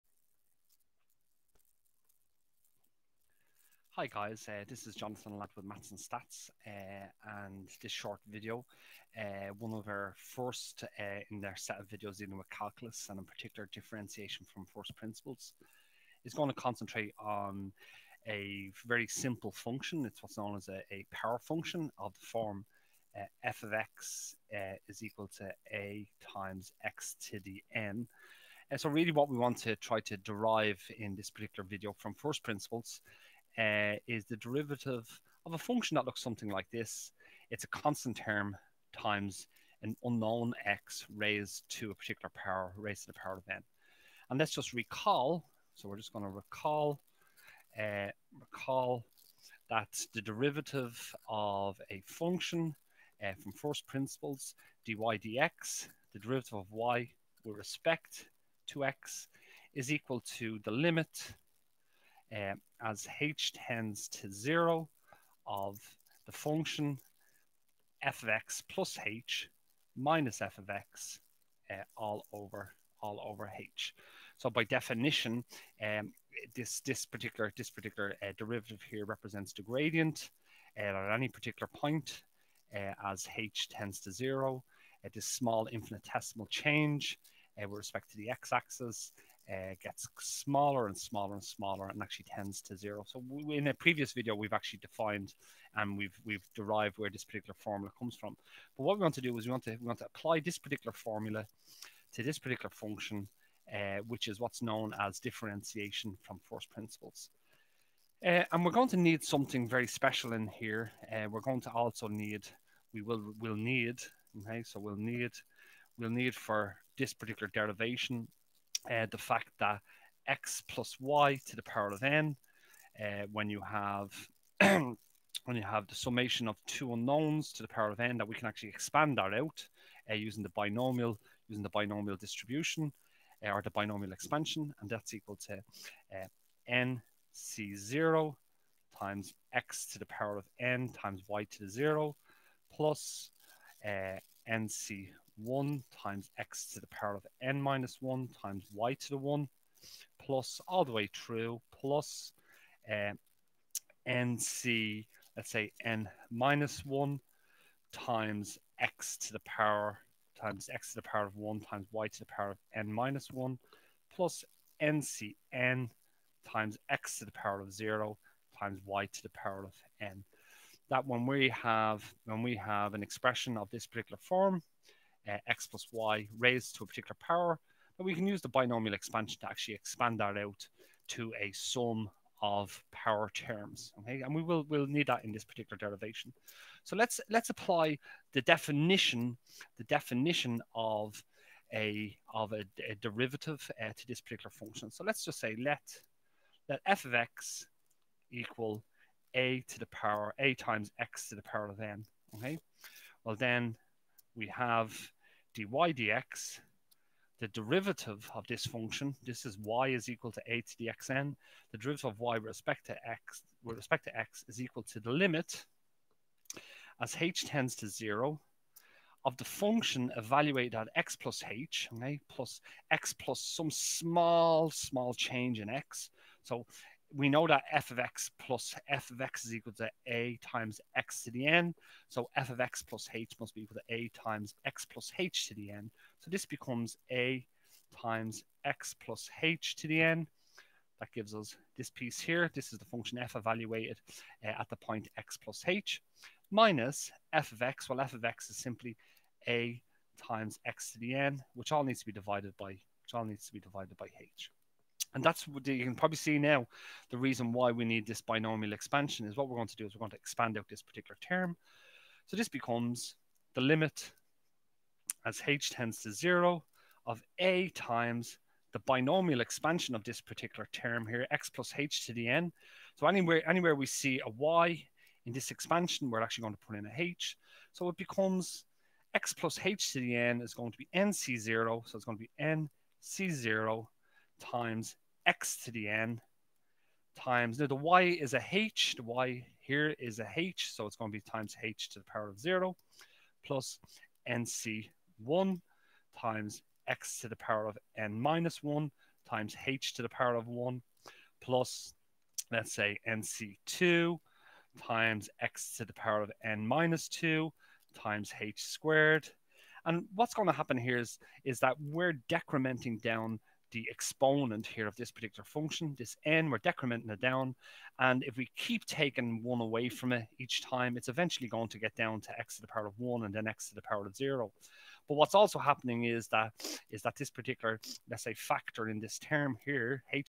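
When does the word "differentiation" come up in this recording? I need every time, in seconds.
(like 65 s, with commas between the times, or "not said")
13 s, 105 s.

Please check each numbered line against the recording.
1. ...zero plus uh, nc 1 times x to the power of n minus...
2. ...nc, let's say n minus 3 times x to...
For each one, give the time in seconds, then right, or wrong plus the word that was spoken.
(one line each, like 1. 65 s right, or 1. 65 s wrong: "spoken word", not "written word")
1. 141 s right
2. 154 s wrong: "1", not "3".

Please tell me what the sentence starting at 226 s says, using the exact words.
So we know that f of x plus f of x is equal to a times x to the n.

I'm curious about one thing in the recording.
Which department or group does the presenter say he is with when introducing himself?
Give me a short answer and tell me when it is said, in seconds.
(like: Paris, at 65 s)
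Maths and Stats, at 5 s.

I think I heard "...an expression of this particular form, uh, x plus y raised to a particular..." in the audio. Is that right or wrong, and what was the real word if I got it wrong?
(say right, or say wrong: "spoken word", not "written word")
right.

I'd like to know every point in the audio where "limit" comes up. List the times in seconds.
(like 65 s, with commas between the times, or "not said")
60 s, 215 s, 263 s.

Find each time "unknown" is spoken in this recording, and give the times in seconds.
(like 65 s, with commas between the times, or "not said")
40 s, 126 s.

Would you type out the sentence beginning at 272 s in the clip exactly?
So anywhere, anywhere we see a y in this expansion, we're actually going to put in a h.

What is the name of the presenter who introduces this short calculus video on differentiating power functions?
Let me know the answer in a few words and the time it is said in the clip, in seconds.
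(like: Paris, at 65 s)
Jonathan Latt, at 4 s.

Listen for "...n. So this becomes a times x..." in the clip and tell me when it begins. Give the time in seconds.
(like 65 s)
235 s.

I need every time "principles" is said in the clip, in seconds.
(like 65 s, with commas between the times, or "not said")
14 s, 32 s, 53 s, 106 s.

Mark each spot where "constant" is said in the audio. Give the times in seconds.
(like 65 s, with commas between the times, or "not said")
37 s.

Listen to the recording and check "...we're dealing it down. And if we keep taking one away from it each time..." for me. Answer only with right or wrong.
wrong.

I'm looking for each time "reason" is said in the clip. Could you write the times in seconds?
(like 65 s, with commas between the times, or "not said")
257 s.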